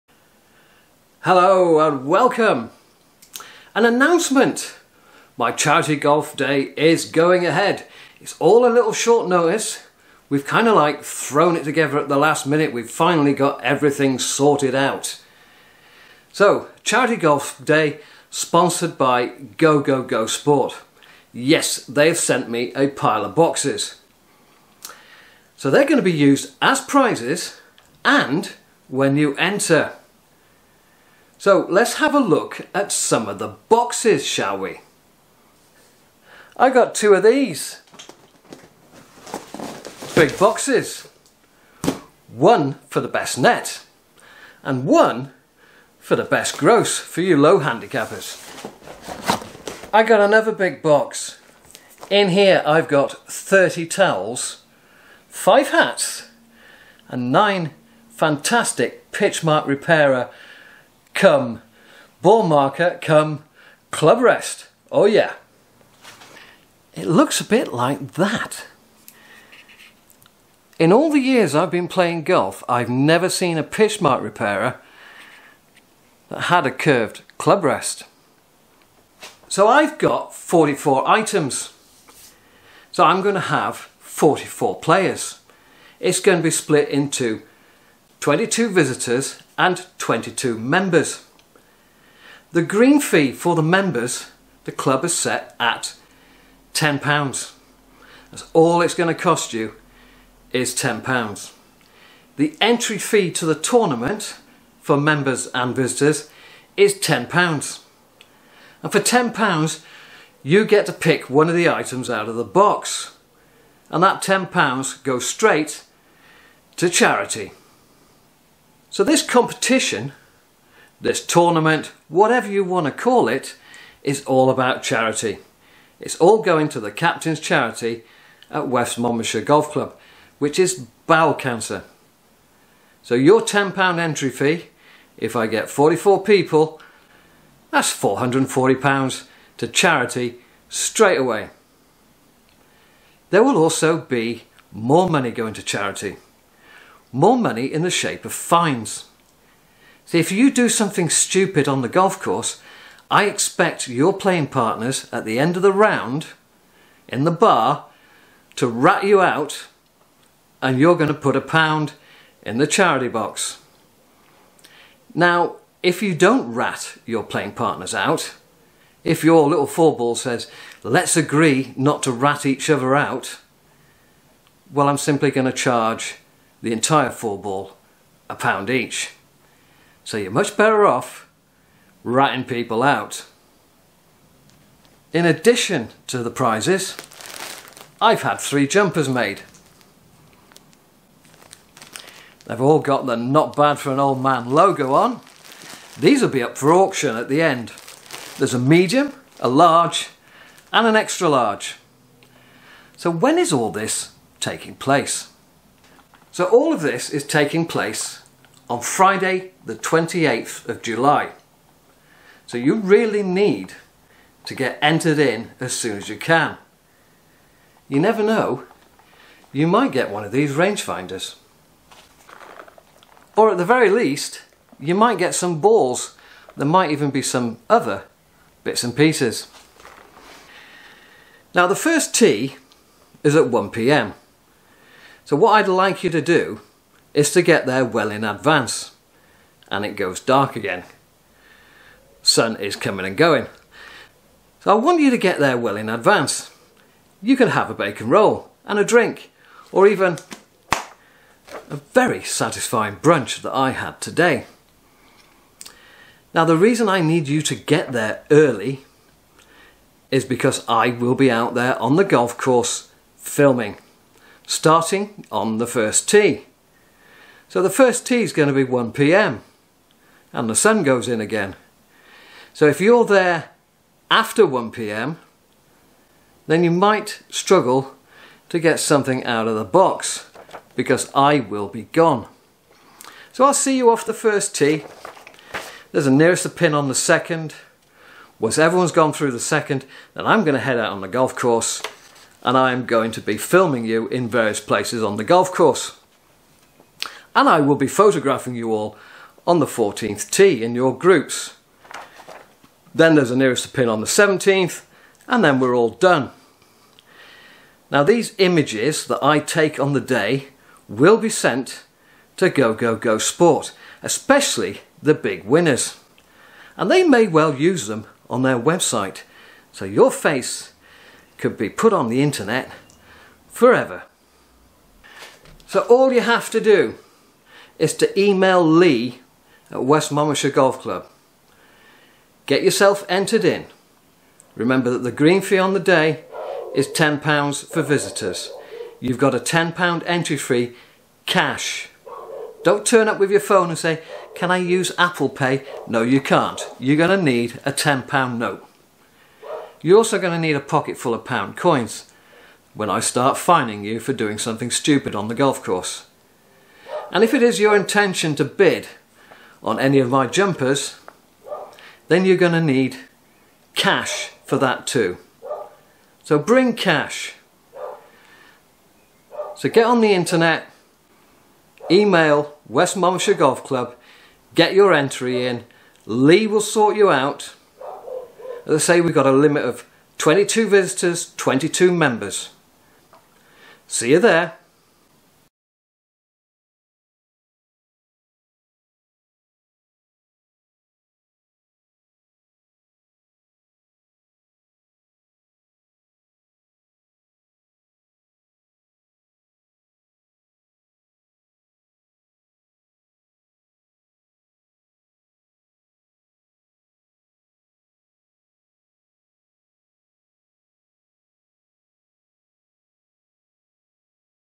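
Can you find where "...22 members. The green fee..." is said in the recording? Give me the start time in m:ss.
1:29.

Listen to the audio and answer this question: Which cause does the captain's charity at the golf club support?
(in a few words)
bowel cancer.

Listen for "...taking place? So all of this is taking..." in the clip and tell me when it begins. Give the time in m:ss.
3:24.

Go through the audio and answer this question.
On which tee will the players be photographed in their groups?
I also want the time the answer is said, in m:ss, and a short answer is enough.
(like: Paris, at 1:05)
14th, at 4:59.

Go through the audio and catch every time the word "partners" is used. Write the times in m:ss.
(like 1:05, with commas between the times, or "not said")
2:34, 2:47.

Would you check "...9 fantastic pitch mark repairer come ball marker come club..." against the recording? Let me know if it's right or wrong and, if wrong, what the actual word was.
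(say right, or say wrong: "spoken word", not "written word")
right.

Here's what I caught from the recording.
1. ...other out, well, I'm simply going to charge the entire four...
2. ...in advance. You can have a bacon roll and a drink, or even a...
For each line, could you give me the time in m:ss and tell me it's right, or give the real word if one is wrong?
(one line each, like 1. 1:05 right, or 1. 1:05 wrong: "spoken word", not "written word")
1. 2:52 right
2. 4:05 right.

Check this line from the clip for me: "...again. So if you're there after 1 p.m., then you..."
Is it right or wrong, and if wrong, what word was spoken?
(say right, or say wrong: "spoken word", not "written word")
right.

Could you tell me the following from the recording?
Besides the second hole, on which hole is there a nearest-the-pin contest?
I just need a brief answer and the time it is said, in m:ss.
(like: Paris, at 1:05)
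17th, at 5:04.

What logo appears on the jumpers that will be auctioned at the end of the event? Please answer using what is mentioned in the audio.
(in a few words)
Not Bad for an Old Man.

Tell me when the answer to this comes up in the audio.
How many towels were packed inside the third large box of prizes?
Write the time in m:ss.
0:53.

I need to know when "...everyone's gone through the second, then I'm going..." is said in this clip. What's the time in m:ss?
4:48.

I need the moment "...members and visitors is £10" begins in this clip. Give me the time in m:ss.
1:44.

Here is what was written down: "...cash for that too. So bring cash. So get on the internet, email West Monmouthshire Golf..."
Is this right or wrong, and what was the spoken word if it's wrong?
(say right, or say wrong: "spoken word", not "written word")
right.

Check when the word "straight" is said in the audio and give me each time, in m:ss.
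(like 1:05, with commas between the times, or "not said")
1:55, 2:20.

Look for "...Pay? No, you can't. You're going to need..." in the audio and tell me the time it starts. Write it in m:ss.
5:45.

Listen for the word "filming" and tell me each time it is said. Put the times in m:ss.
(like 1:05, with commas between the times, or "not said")
4:23, 4:53.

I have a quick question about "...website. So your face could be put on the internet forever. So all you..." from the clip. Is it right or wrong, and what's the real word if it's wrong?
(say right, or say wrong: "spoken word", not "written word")
right.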